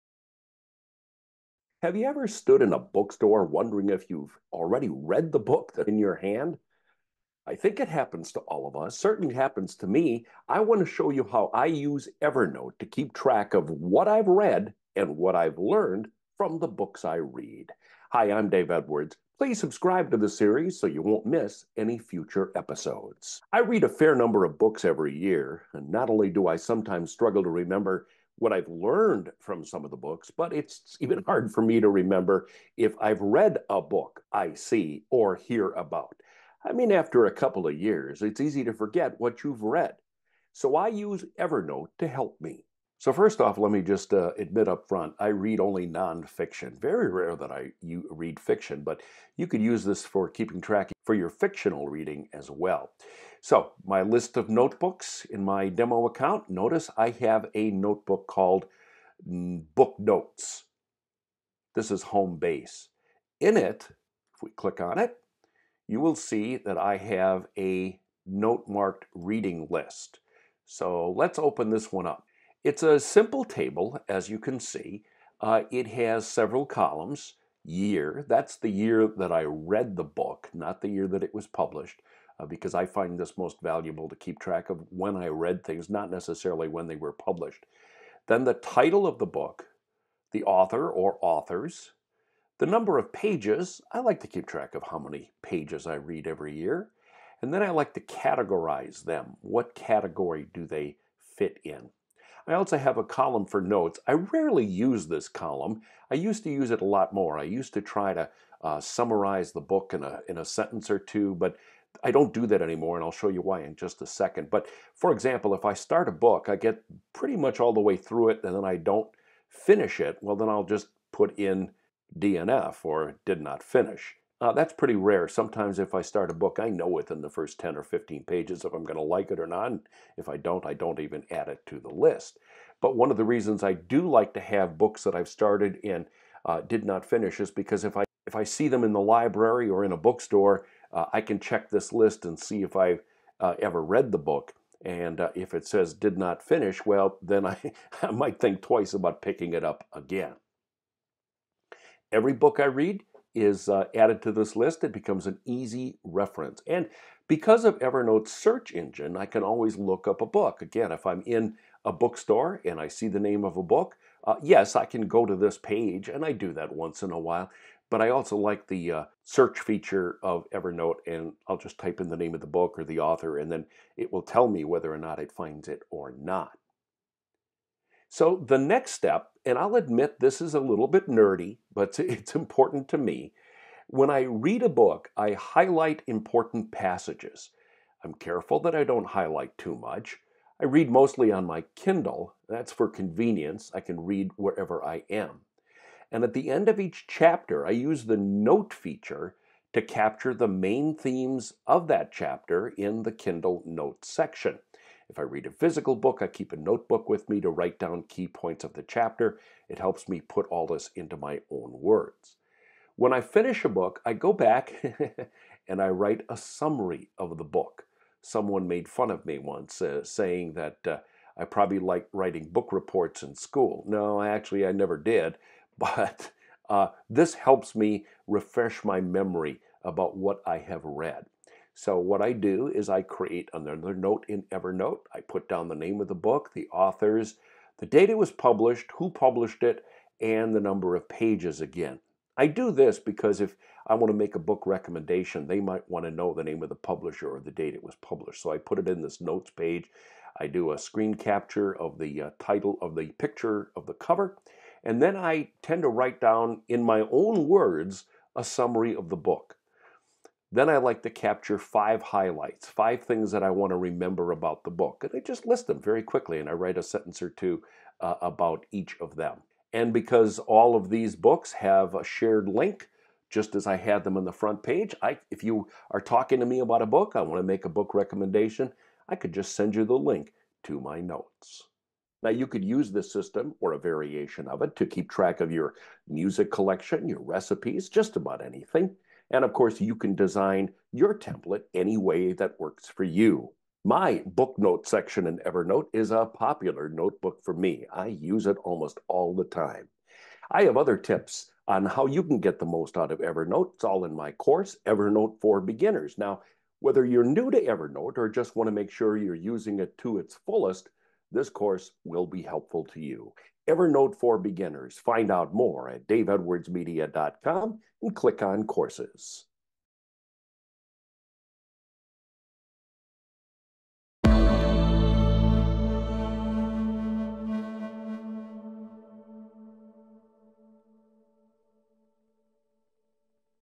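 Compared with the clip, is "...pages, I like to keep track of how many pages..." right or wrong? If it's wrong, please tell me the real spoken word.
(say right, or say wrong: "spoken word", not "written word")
right.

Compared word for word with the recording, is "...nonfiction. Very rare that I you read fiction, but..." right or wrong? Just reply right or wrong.
right.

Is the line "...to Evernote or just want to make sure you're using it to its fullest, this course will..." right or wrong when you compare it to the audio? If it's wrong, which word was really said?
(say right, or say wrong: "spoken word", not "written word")
right.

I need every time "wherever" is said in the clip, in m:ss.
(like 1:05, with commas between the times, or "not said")
3:14.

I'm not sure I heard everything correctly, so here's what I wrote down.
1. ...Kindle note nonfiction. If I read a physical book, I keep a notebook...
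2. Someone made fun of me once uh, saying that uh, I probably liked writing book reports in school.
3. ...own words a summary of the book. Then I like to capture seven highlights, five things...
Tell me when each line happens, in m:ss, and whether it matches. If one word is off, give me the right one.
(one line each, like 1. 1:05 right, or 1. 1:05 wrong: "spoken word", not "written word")
1. 3:23 wrong: "section", not "nonfiction"
2. 3:38 right
3. 4:17 wrong: "five", not "seven".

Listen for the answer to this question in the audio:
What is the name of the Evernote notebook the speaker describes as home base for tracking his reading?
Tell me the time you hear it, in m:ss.
0:59.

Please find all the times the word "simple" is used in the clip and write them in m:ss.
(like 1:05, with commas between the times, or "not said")
1:12.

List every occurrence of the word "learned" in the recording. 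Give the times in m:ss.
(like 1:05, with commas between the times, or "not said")
0:15, 0:28.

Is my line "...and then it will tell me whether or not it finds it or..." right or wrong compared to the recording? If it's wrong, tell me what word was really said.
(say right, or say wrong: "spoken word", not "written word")
right.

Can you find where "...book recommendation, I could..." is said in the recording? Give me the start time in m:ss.
4:37.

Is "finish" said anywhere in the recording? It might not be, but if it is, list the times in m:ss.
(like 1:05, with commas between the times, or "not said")
1:59, 2:03, 2:17, 2:26, 3:33.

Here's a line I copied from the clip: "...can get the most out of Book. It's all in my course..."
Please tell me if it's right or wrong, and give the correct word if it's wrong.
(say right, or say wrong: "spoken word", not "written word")
wrong: "Evernote", not "Book".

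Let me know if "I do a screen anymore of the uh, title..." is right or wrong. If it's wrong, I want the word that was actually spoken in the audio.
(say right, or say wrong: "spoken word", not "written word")
wrong: "capture", not "anymore".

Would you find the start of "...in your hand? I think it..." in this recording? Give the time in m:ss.
0:05.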